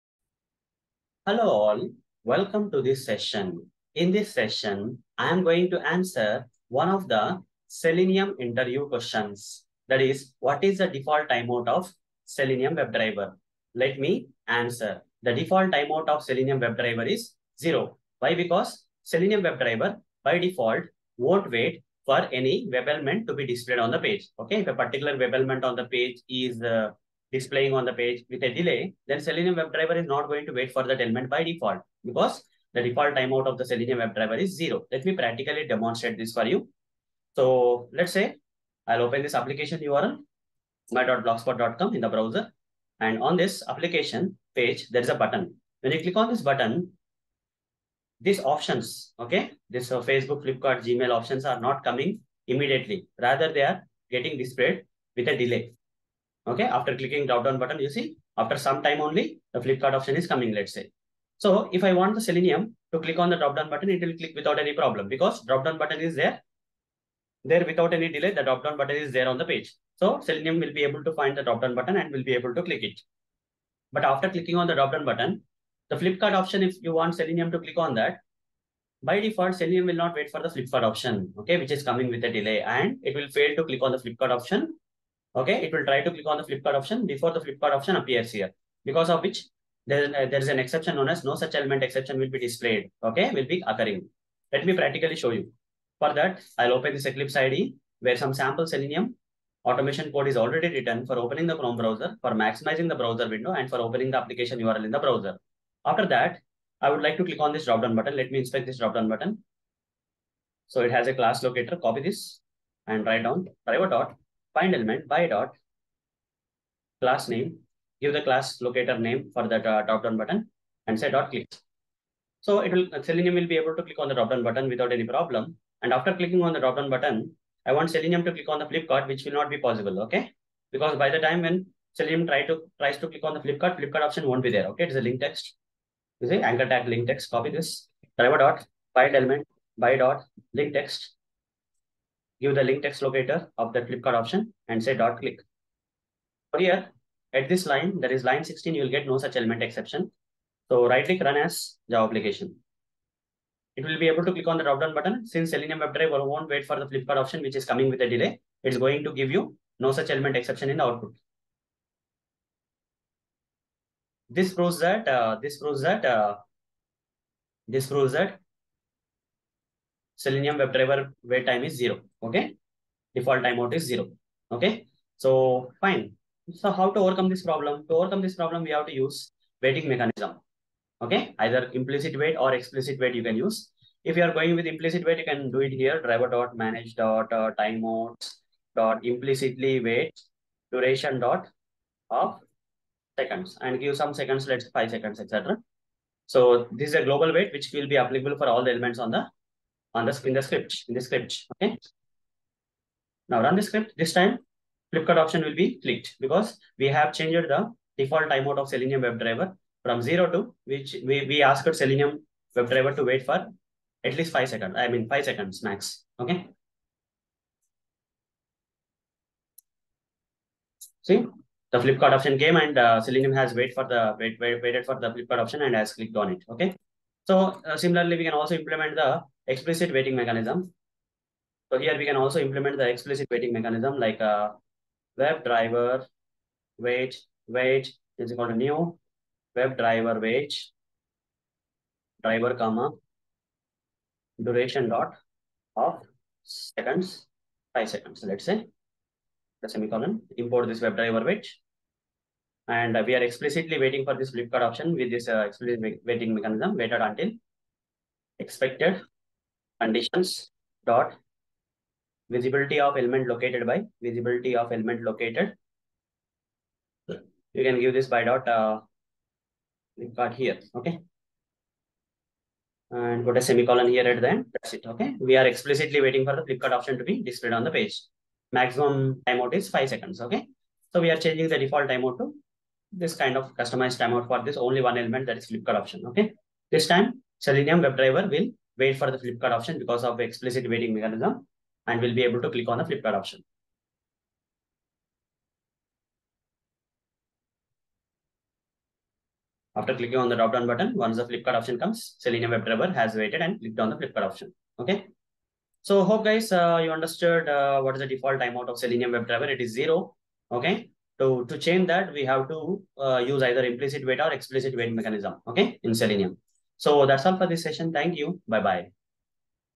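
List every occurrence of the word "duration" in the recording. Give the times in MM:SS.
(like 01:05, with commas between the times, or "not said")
03:10, 04:04.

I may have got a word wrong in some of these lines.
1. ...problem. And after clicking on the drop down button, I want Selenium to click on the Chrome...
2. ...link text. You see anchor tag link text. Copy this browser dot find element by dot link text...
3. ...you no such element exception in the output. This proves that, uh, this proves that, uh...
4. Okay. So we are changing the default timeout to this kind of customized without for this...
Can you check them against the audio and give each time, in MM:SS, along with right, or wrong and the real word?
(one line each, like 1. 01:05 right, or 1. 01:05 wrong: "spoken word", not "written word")
1. 02:05 wrong: "Flipkart", not "Chrome"
2. 02:15 wrong: "driver", not "browser"
3. 02:39 right
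4. 04:40 wrong: "timeout", not "without".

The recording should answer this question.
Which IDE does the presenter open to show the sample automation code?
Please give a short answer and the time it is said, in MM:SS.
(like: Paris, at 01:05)
Eclipse, at 01:37.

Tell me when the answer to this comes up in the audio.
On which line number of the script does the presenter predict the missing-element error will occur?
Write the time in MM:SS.
02:28.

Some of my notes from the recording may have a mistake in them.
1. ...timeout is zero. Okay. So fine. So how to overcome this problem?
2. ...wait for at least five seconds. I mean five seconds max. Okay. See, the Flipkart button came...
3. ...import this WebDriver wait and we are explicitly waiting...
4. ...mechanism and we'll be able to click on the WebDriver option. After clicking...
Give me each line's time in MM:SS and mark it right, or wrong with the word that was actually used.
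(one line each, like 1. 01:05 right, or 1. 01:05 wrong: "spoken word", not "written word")
1. 02:53 right
2. 03:33 wrong: "option", not "button"
3. 04:10 right
4. 04:50 wrong: "Flipkart", not "WebDriver".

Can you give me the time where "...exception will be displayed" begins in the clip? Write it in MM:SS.
01:31.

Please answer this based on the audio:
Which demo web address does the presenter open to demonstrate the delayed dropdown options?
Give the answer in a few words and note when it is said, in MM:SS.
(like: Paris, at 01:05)
my.blogspot.com, at 00:40.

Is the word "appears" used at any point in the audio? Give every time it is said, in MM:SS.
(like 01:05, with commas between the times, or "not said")
01:27.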